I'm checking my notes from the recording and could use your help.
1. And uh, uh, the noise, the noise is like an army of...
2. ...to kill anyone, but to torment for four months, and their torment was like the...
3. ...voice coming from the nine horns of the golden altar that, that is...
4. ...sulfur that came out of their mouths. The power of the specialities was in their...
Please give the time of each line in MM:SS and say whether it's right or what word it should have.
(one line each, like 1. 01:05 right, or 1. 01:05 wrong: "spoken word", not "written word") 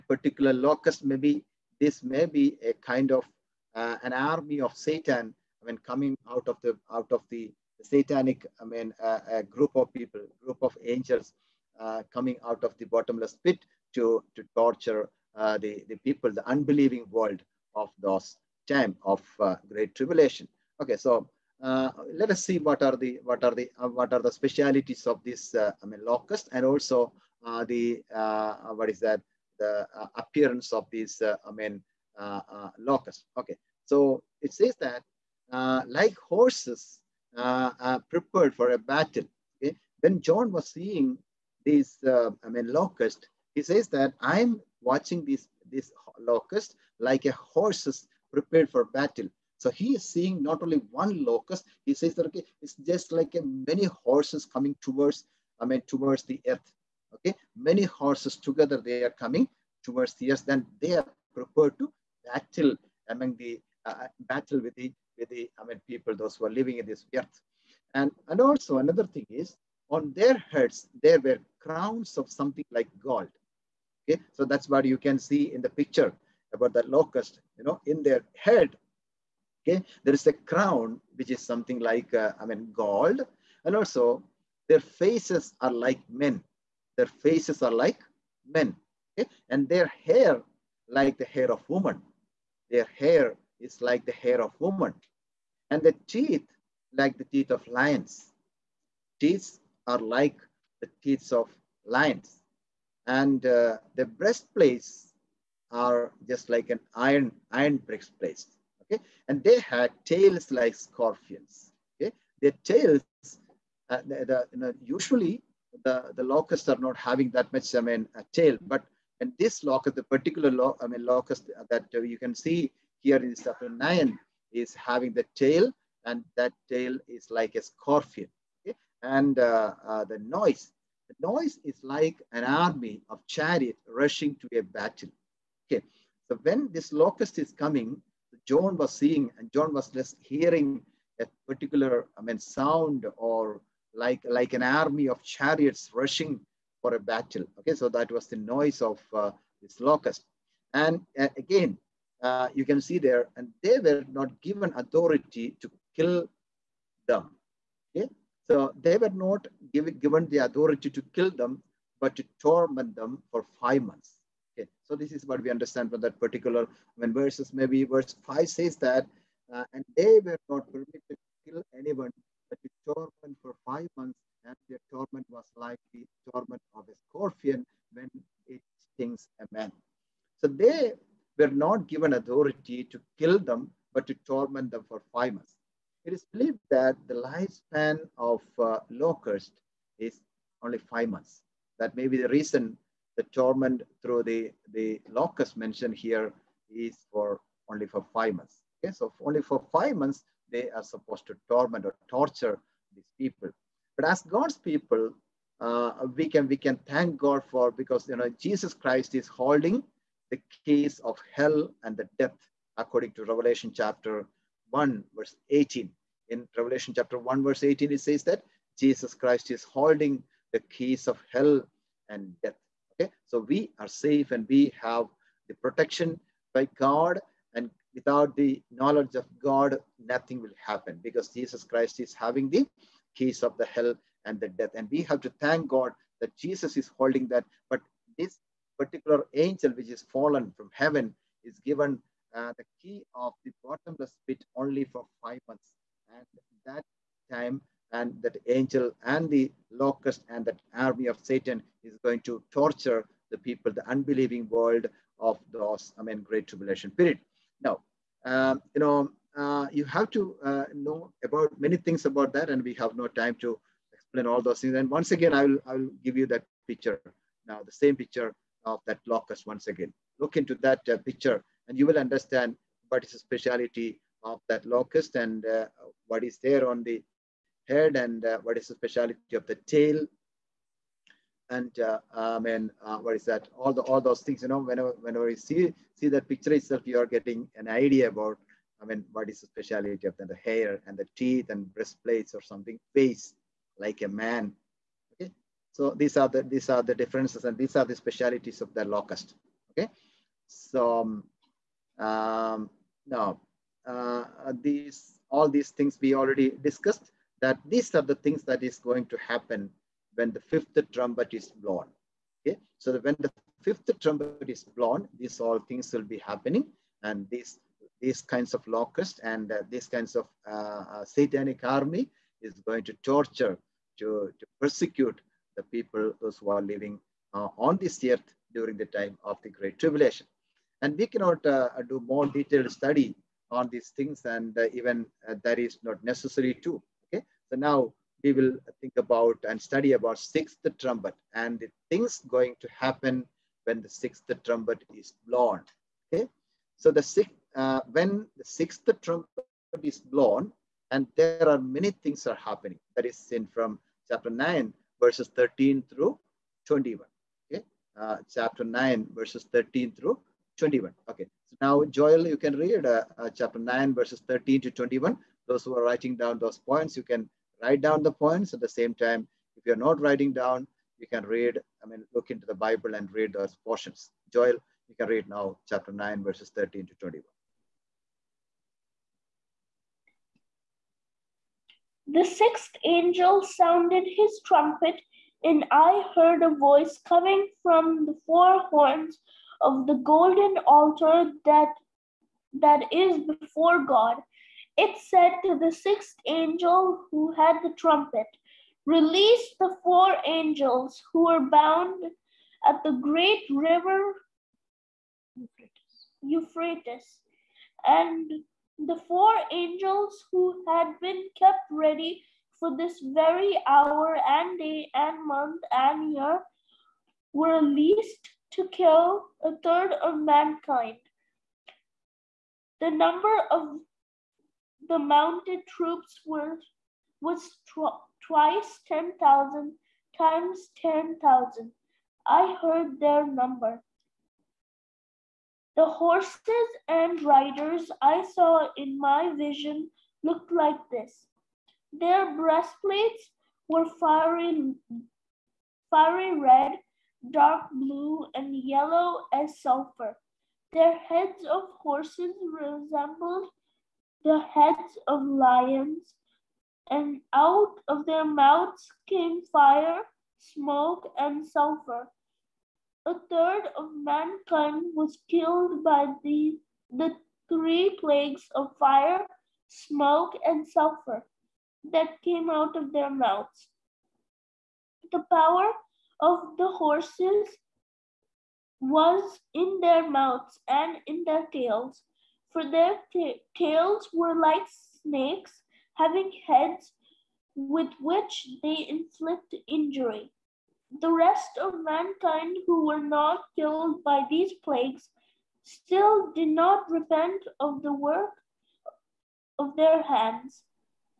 1. 02:09 right
2. 02:51 wrong: "five", not "four"
3. 06:26 wrong: "four", not "nine"
4. 07:50 wrong: "horses", not "specialities".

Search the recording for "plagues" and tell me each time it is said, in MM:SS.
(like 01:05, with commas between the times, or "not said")
07:47, 08:14.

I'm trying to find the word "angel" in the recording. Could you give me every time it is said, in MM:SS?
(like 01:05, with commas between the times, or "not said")
00:10, 03:59, 04:08, 06:22, 06:36, 06:40, 06:49.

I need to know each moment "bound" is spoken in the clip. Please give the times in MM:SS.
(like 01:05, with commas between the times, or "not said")
06:41.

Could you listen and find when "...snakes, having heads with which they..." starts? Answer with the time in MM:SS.
08:05.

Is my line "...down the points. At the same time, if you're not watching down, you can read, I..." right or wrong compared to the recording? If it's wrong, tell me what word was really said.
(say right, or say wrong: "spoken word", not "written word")
wrong: "writing", not "watching".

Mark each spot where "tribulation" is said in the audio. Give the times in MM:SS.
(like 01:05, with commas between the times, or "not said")
00:19, 04:16, 05:29.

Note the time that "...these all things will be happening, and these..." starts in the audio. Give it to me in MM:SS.
05:15.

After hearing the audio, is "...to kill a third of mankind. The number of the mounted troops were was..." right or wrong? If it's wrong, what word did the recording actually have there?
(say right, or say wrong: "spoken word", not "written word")
right.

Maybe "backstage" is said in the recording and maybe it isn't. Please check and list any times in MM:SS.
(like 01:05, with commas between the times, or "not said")
not said.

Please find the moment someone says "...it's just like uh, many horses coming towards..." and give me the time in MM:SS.
00:52.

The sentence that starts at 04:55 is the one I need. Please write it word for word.
Okay, so these are the these are the differences and these are the specialities of the locust.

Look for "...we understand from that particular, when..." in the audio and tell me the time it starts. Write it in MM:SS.
02:45.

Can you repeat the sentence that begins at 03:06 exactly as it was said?
It is believed that the lifespan of uh, locust is only five months.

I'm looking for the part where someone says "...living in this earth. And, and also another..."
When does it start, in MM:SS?
01:06.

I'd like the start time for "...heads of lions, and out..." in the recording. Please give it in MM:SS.
07:34.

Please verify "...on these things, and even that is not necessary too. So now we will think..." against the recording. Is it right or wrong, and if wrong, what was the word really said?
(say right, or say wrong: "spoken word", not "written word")
right.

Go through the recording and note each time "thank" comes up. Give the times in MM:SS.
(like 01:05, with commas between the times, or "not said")
03:26, 03:55.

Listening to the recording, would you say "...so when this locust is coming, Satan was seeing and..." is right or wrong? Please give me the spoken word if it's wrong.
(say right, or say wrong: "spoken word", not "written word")
wrong: "John", not "Satan".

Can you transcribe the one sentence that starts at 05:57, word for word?
Okay, uh, chapter nine verses thirteen through 21.